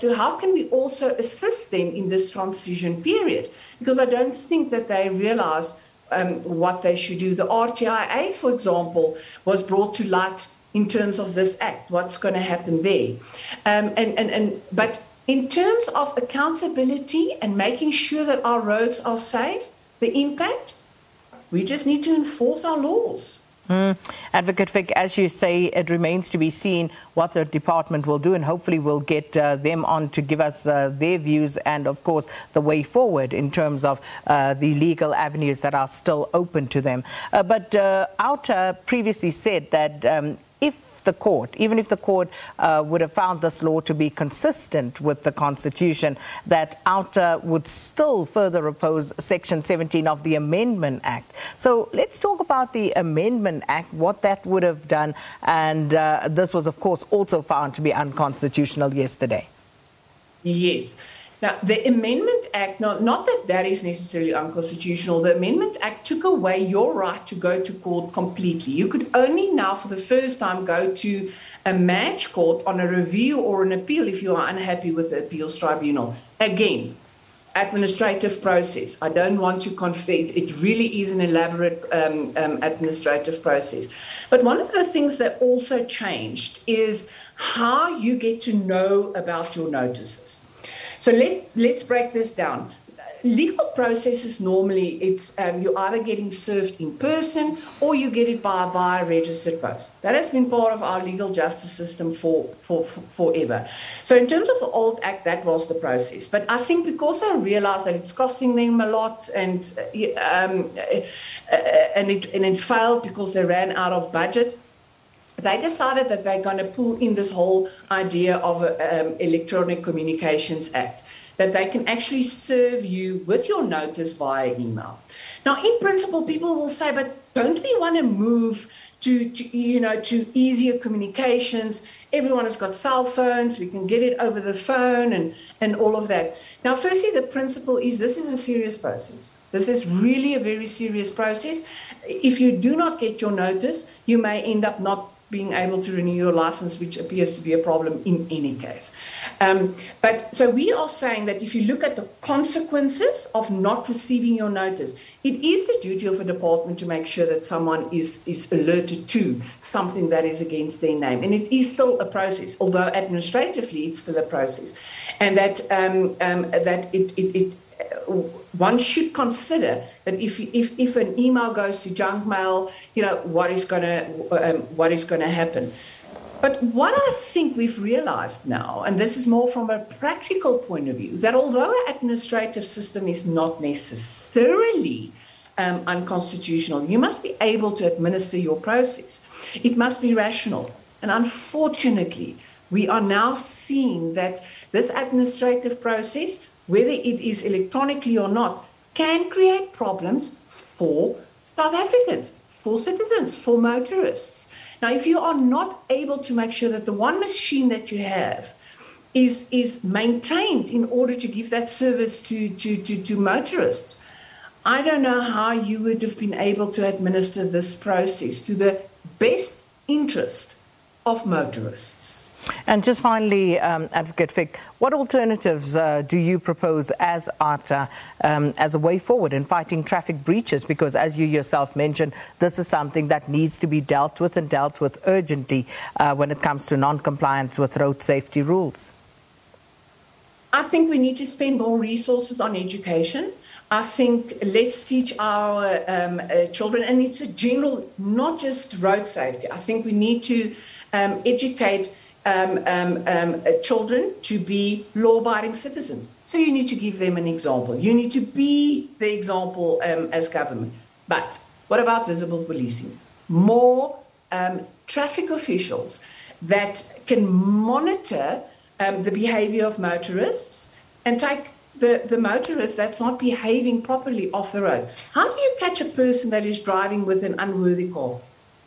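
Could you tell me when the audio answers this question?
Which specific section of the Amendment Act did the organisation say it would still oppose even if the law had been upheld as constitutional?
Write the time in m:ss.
0:49.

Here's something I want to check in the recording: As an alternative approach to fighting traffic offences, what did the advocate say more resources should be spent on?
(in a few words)
Education.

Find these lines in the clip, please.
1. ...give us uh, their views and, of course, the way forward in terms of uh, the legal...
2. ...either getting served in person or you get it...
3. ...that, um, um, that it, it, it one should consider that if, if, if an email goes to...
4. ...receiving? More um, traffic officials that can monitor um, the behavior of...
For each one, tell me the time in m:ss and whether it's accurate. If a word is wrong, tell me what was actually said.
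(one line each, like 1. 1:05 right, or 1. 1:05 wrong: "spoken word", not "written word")
1. 0:30 right
2. 1:35 right
3. 2:45 right
4. 4:22 wrong: "policing", not "receiving".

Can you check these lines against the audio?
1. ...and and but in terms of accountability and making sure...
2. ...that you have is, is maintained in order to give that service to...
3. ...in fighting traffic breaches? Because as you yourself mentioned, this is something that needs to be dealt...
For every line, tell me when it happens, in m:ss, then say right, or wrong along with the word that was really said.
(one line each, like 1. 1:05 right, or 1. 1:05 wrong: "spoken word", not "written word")
1. 0:14 right
2. 3:27 right
3. 3:49 right.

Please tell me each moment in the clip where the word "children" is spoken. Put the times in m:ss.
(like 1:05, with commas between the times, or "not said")
4:06, 4:13.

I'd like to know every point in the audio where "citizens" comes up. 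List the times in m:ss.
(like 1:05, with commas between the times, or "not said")
3:22, 4:15.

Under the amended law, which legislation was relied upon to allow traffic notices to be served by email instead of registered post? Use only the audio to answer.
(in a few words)
Electronic Communications Act.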